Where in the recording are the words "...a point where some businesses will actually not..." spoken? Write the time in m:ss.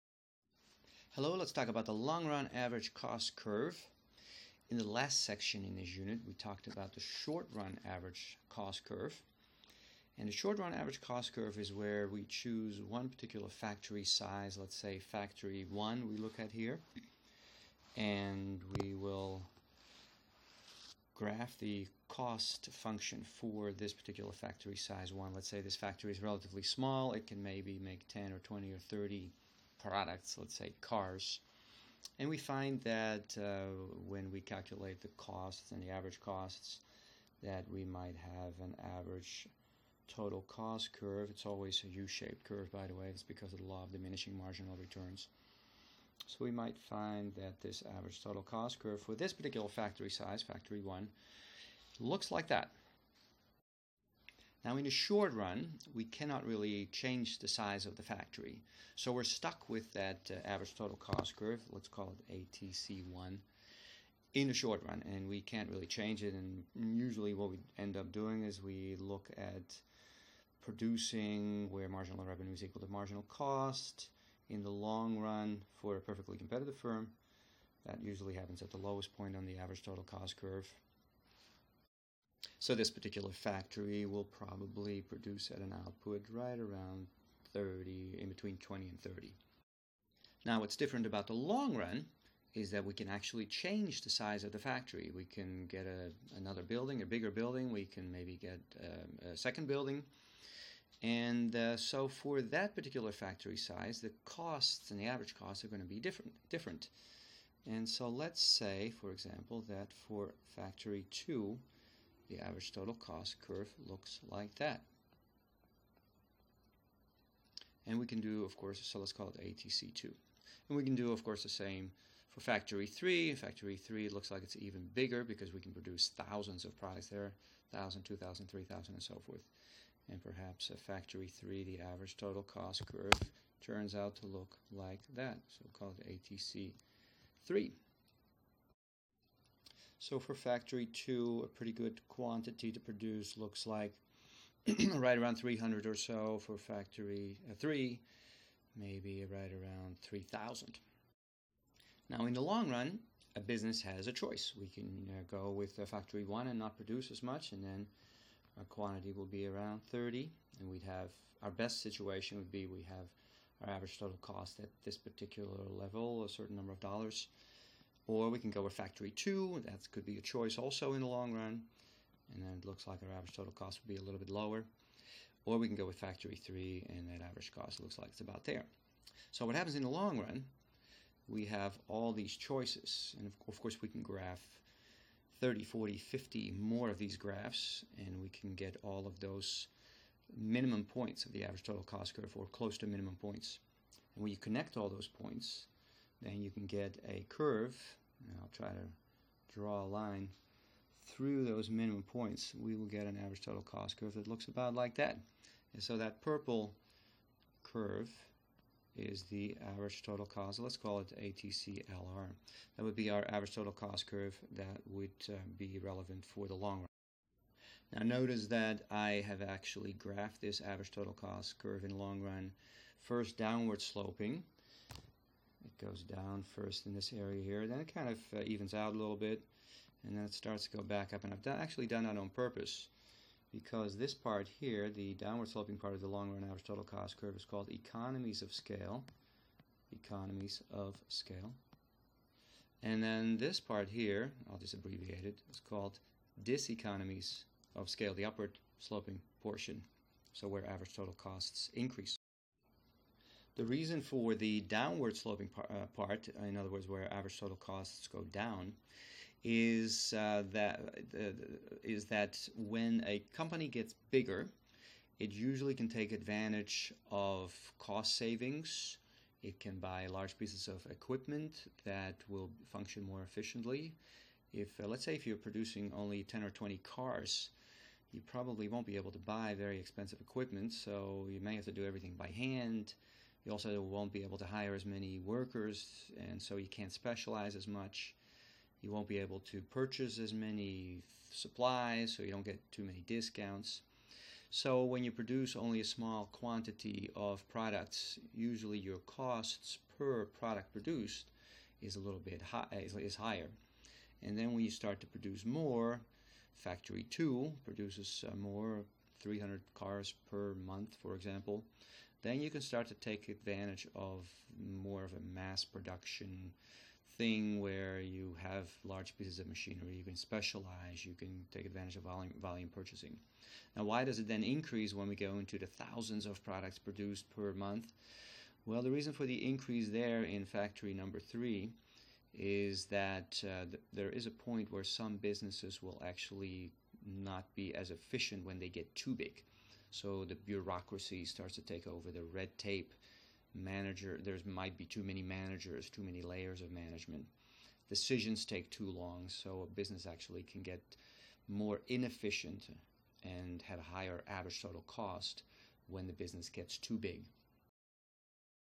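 5:34.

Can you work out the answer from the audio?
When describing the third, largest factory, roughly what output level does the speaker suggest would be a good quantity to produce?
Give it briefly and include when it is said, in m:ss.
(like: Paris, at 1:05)
3,000, at 2:28.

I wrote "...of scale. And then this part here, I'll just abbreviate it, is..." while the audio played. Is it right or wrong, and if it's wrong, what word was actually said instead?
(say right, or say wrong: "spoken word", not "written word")
right.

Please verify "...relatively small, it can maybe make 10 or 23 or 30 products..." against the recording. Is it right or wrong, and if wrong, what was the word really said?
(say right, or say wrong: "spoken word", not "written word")
wrong: "20", not "23".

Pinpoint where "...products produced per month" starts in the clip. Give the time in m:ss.
5:26.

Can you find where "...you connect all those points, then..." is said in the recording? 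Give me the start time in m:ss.
3:14.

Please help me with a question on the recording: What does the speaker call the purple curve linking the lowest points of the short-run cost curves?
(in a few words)
ATCLR.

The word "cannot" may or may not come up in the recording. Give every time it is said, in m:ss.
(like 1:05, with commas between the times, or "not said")
0:56.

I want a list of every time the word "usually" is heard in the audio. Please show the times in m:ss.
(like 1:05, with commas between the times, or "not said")
1:06, 1:18, 4:25, 4:58.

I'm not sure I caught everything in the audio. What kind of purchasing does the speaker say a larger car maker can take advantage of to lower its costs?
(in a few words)
volume purchasing.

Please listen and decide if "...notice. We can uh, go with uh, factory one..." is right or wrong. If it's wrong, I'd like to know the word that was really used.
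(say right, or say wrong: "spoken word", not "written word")
wrong: "choice", not "notice".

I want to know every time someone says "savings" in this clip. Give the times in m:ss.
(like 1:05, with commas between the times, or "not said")
4:28.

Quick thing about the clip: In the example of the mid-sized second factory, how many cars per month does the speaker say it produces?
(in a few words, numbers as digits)
300.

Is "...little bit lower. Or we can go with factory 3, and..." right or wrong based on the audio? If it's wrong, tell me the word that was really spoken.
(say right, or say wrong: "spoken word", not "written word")
right.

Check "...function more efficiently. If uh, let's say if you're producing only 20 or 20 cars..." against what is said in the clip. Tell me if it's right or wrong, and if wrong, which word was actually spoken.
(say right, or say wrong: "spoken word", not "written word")
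wrong: "10", not "20".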